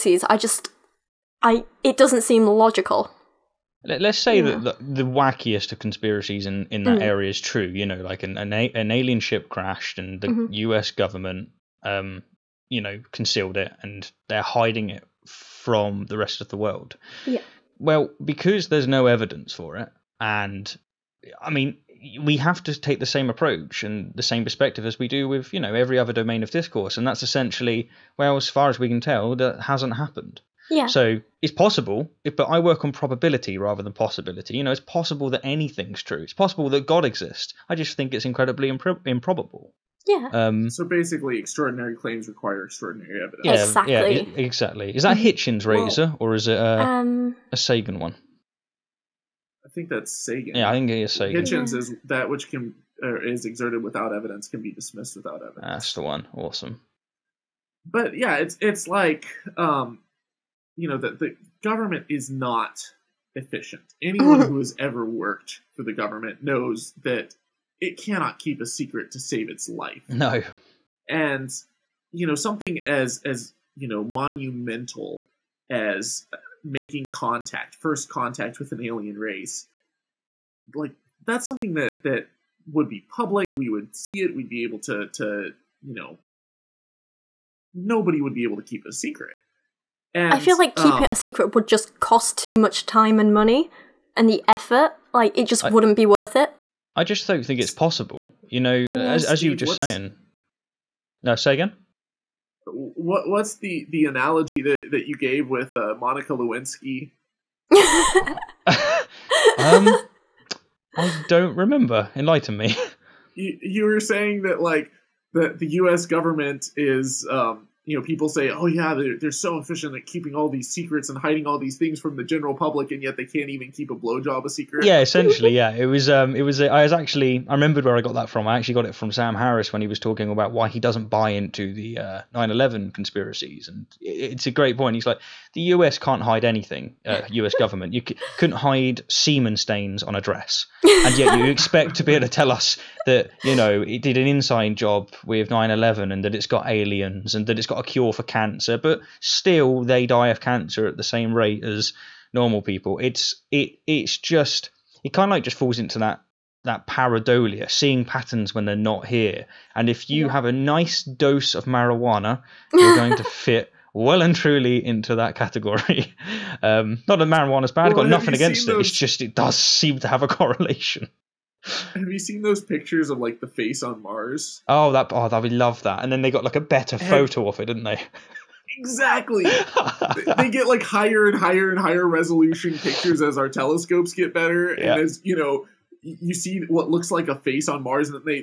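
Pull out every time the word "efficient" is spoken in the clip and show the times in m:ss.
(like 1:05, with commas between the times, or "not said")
1:03, 1:59.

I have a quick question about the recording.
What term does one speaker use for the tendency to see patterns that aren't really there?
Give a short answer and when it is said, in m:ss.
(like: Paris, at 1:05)
pareidolia, at 2:36.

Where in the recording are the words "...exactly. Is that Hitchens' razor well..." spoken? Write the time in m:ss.
0:44.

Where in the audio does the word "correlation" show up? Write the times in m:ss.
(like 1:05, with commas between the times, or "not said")
2:50.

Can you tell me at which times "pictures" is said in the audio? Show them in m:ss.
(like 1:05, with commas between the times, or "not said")
2:52, 3:02.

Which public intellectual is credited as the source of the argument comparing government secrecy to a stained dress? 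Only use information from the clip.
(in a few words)
Sam Harris.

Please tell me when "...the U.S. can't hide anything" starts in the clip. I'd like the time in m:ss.
2:15.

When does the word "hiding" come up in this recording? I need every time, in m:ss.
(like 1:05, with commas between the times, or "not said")
0:14, 2:01.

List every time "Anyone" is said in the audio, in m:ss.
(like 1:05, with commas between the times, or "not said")
1:04.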